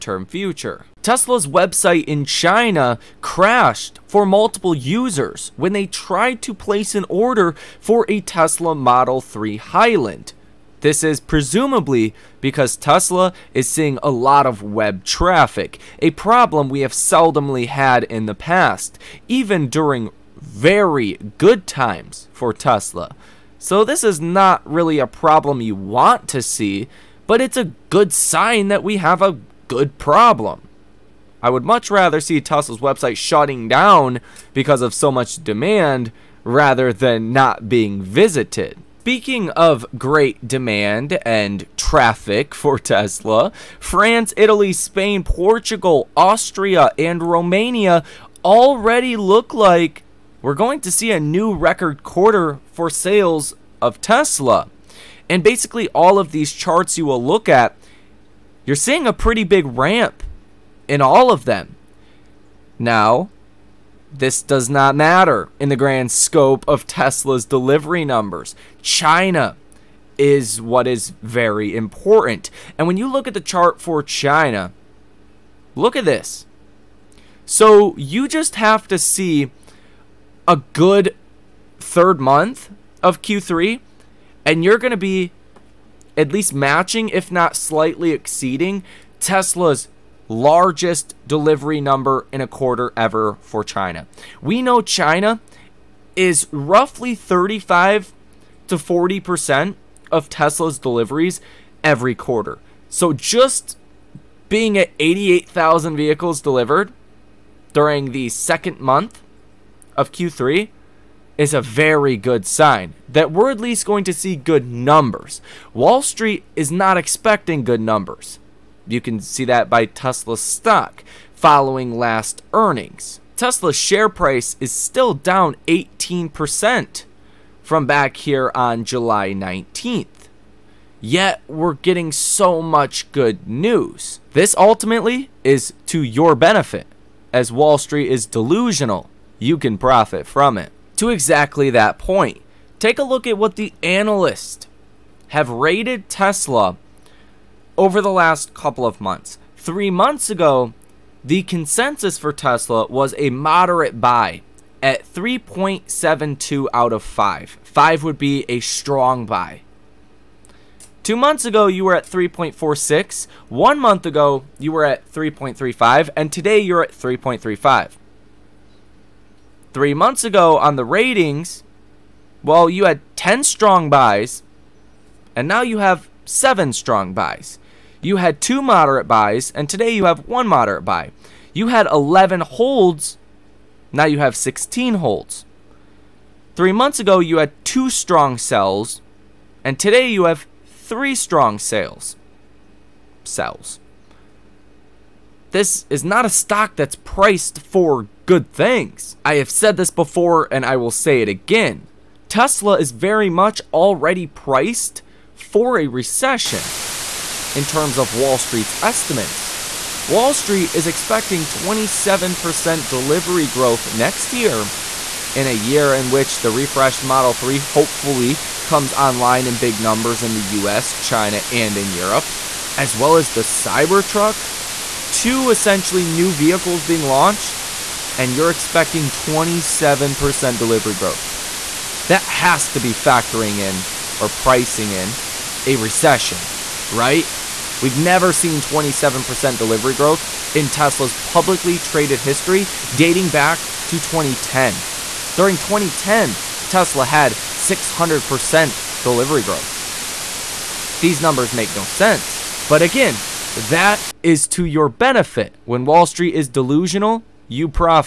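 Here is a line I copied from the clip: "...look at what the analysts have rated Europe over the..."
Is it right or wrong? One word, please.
wrong.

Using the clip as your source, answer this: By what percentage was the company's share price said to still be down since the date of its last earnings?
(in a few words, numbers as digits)
18%.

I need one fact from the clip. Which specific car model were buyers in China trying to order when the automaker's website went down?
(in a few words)
Model 3 Highland.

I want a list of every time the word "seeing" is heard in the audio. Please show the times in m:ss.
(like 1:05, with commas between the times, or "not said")
0:13, 0:58.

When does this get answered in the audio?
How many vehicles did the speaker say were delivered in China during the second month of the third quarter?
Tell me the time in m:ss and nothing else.
1:44.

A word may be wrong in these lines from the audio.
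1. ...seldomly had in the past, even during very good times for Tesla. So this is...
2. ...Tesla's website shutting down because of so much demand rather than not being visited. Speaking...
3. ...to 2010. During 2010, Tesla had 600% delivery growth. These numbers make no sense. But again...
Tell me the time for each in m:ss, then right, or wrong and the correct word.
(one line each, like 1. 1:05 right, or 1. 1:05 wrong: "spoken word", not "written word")
1. 0:16 right
2. 0:32 right
3. 4:03 right.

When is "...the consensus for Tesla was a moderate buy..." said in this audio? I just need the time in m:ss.
2:31.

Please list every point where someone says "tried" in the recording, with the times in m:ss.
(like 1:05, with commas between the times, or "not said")
0:05.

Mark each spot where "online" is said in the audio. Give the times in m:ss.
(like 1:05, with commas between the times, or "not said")
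3:38.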